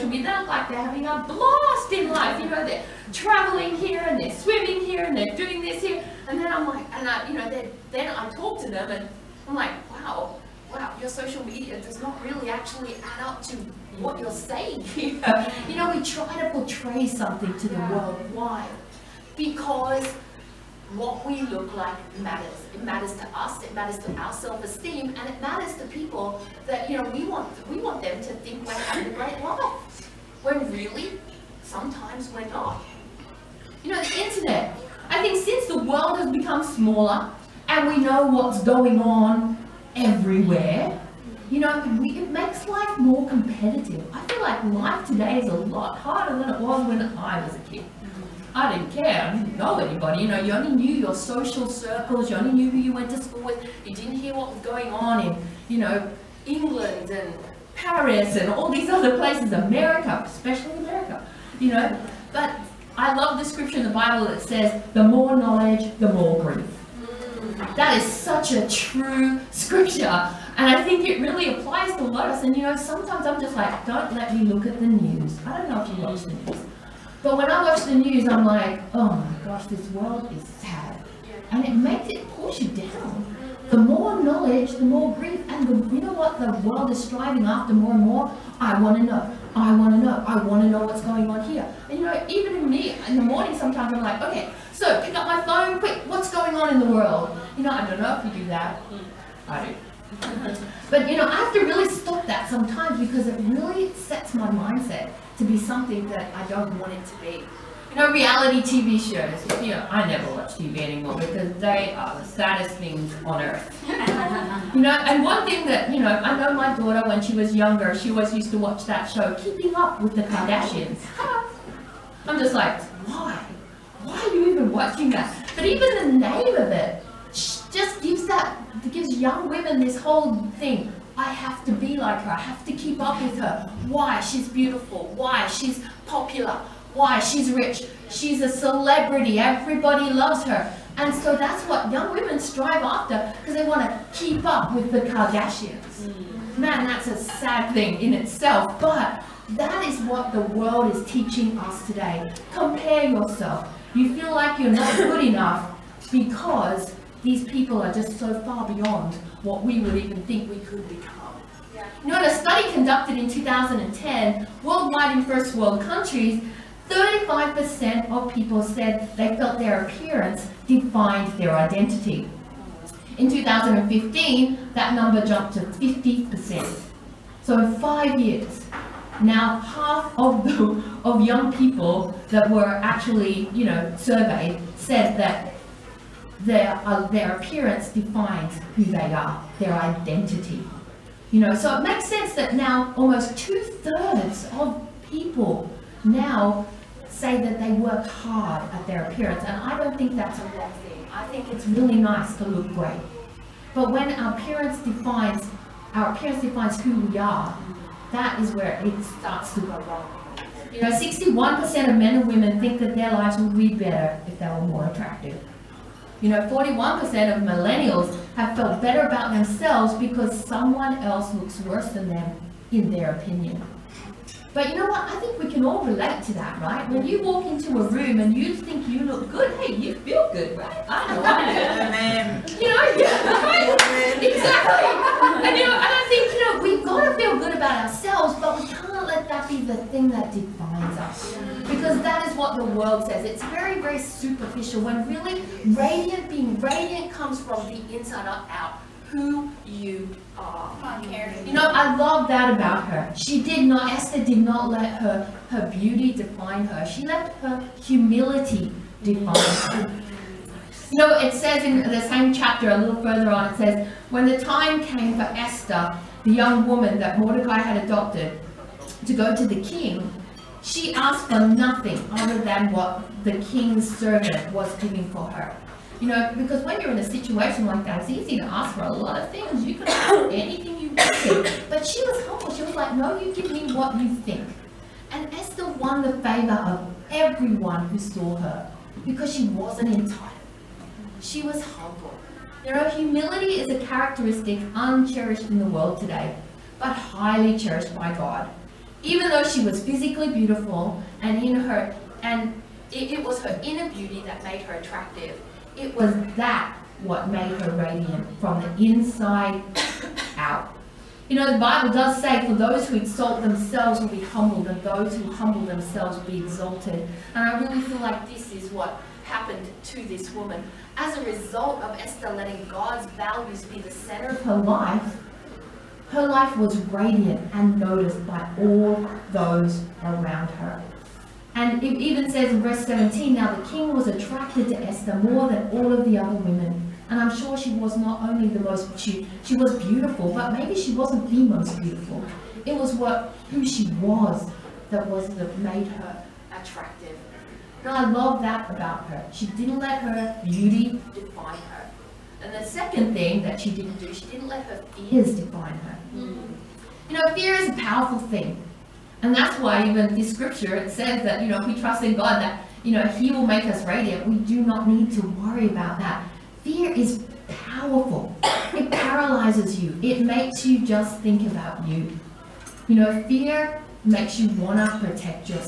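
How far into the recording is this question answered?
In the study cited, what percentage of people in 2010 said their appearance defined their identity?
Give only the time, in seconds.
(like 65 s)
166 s.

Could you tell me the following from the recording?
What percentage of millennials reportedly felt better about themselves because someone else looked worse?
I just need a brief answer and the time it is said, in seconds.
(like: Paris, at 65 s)
41%, at 216 s.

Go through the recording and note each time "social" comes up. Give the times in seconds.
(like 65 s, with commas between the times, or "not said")
11 s, 51 s.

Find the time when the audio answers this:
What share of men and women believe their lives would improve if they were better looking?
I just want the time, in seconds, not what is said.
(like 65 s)
210 s.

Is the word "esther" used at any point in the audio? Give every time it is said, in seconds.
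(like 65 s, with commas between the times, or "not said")
253 s, 265 s, 285 s, 321 s, 334 s.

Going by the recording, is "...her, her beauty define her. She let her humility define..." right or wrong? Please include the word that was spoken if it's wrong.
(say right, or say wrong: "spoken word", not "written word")
right.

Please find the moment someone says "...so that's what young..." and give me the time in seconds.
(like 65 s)
141 s.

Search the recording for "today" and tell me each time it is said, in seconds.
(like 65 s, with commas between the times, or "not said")
45 s, 151 s, 295 s.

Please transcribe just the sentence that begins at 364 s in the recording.
We do not need to worry about that.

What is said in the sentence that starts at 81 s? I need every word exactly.
And it makes it push you down.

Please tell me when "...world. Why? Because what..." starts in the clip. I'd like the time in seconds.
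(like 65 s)
17 s.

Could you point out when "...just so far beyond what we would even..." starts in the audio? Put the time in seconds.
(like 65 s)
157 s.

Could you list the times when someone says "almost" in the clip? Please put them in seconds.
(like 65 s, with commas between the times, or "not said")
192 s.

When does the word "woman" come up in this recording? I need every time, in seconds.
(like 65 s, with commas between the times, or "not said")
266 s, 320 s.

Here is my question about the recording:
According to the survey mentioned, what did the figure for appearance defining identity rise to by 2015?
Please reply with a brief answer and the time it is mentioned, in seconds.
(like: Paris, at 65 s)
50%, at 175 s.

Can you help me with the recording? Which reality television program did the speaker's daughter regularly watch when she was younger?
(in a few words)
Keeping Up with the Kardashians.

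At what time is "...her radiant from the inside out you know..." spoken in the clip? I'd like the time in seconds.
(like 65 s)
307 s.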